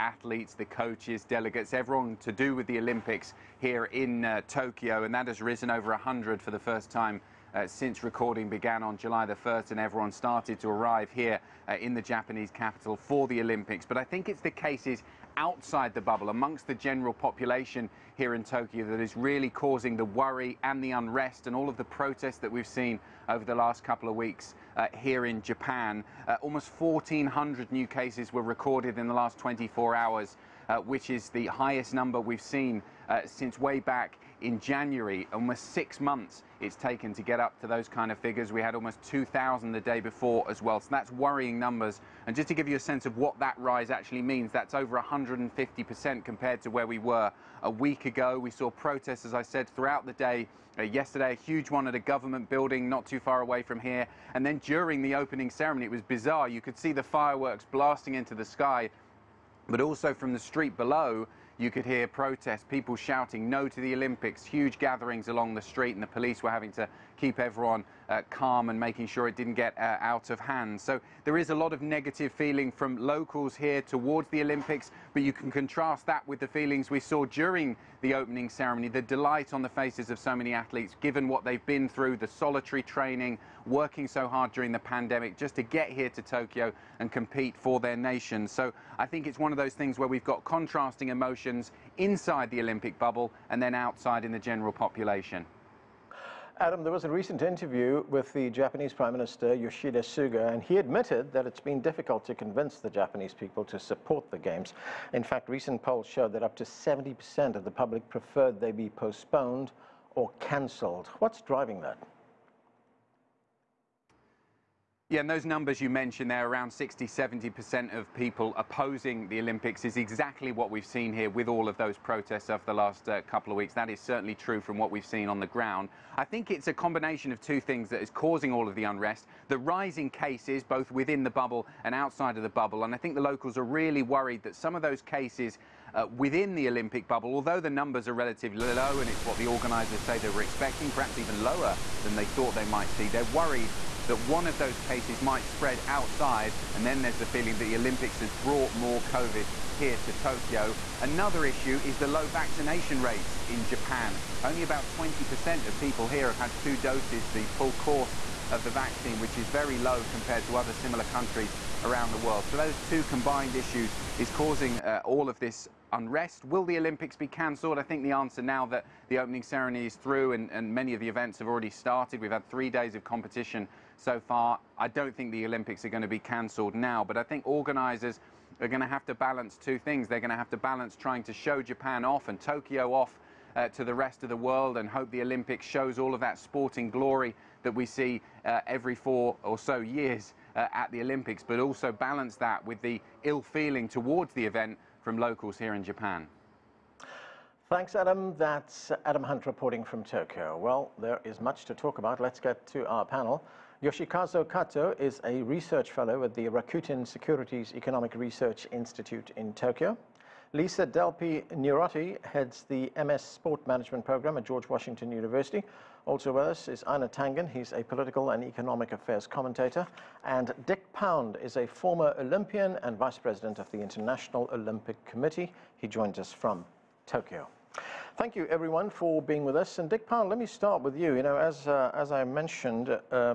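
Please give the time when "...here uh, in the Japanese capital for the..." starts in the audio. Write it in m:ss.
0:11.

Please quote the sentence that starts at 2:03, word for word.
That is certainly true from what we've seen on the ground.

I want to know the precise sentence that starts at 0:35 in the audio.
Almost six months it's taken to get up to those kind of figures.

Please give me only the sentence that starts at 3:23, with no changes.
Yoshikazu Kato is a research fellow at the Rakuten Securities Economic Research Institute in Tokyo.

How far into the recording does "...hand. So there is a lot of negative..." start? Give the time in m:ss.
1:10.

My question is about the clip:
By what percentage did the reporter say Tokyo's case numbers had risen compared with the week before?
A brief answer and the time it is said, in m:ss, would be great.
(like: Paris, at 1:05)
150%, at 0:44.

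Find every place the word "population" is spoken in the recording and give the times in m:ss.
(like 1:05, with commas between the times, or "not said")
0:17, 1:34.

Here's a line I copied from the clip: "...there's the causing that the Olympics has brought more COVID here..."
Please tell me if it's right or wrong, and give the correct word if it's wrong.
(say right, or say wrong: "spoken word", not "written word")
wrong: "feeling", not "causing".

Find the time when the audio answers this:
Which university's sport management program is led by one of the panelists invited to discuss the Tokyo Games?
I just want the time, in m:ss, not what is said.
3:34.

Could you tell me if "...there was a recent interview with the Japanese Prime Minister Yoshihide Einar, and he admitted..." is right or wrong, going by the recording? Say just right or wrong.
wrong.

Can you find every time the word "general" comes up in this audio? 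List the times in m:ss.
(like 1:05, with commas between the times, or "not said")
0:16, 1:34.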